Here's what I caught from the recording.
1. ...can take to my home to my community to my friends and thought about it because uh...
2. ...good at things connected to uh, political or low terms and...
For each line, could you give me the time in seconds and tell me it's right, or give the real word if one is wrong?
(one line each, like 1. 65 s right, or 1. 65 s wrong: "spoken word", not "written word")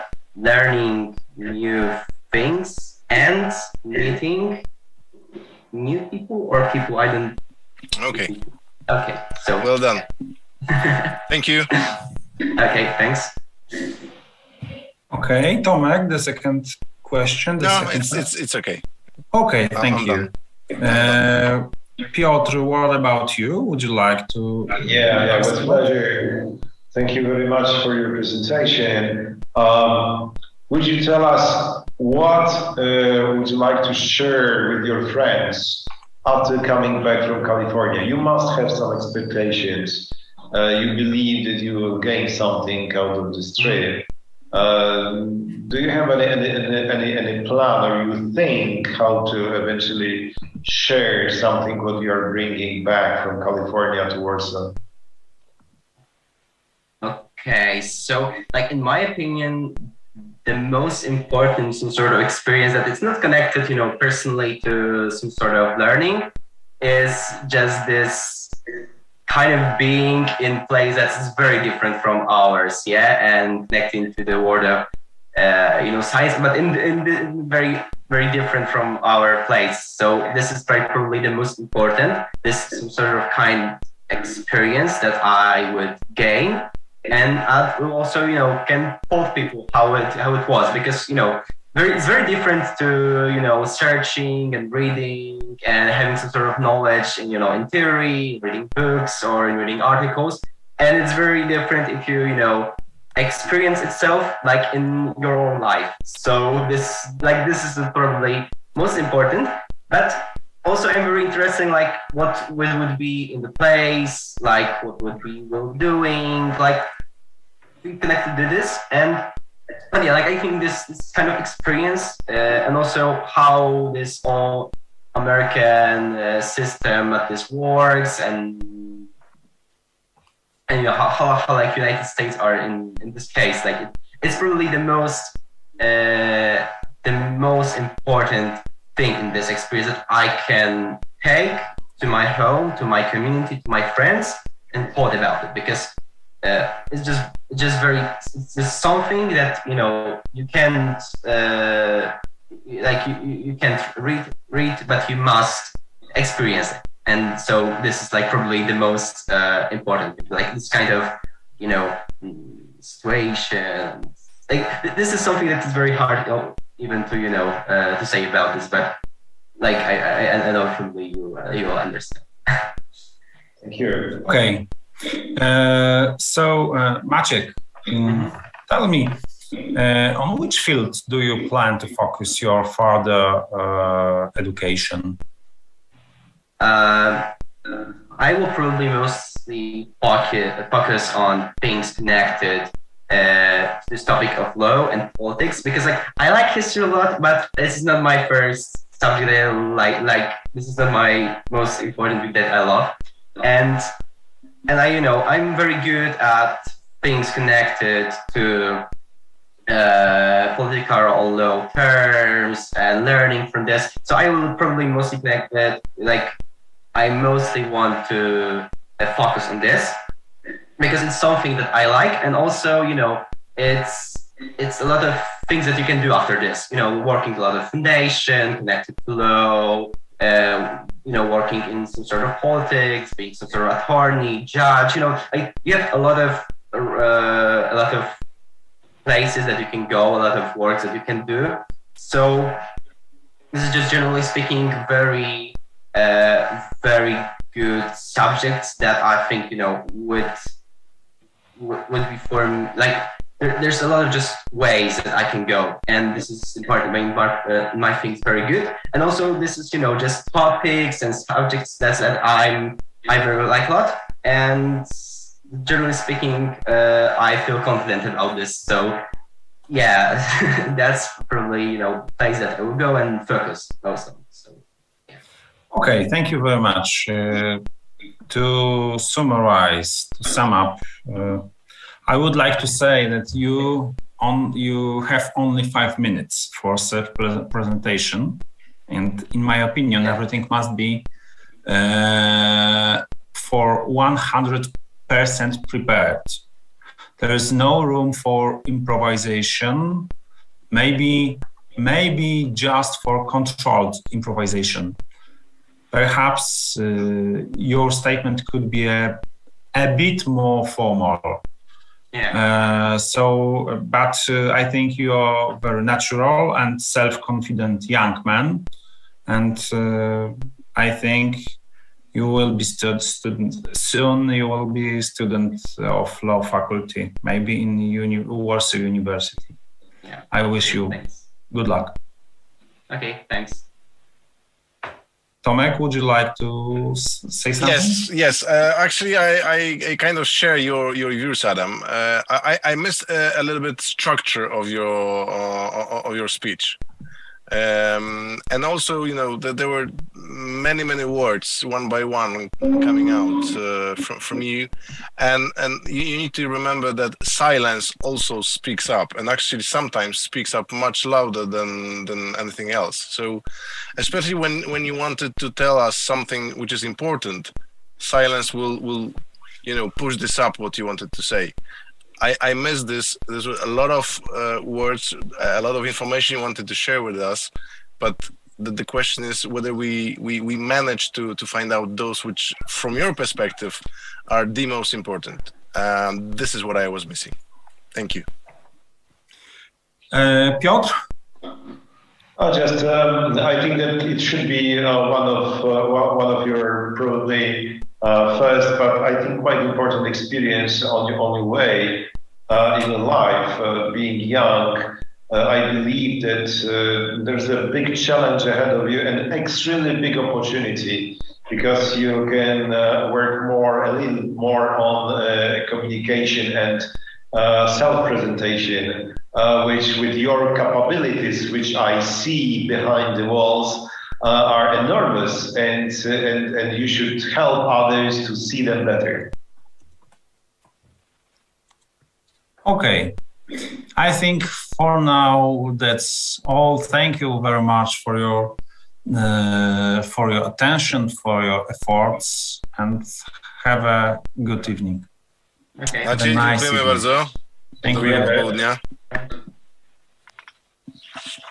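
1. 140 s right
2. 205 s right.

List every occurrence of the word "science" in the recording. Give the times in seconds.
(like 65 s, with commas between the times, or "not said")
76 s.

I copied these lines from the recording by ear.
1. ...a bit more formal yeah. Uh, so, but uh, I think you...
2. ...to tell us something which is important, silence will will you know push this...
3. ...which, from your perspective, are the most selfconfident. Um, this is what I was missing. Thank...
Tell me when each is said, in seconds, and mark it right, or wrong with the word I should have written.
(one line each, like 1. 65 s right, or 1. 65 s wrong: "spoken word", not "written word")
1. 309 s right
2. 365 s right
3. 382 s wrong: "important", not "selfconfident".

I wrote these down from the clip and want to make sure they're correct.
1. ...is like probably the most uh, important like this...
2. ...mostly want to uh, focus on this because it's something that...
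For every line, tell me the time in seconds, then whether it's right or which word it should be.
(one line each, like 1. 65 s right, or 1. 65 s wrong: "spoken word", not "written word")
1. 158 s right
2. 217 s right.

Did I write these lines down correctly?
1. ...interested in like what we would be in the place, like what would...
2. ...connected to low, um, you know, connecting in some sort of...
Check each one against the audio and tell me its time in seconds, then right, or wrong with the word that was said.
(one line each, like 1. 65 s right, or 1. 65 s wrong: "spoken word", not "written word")
1. 111 s right
2. 228 s wrong: "working", not "connecting".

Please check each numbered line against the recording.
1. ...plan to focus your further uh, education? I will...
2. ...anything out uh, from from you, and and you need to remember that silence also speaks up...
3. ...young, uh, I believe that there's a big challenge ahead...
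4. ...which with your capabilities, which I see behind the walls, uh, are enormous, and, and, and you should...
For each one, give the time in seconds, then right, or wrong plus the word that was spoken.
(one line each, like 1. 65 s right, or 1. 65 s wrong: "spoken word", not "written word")
1. 181 s right
2. 352 s wrong: "coming", not "anything"
3. 404 s right
4. 419 s right.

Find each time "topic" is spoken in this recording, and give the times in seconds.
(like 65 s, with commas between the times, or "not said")
194 s, 260 s.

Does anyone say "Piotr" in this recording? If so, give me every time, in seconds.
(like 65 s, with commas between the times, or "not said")
22 s, 390 s.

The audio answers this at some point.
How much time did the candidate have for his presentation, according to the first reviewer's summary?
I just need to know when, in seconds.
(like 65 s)
285 s.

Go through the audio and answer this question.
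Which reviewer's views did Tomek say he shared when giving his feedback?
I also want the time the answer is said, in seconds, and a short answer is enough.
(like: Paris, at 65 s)
Adam, at 341 s.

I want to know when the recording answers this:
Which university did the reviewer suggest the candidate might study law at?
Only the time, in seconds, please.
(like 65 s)
328 s.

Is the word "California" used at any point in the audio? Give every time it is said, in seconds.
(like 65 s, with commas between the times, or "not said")
37 s, 53 s.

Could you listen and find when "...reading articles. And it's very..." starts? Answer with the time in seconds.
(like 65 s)
99 s.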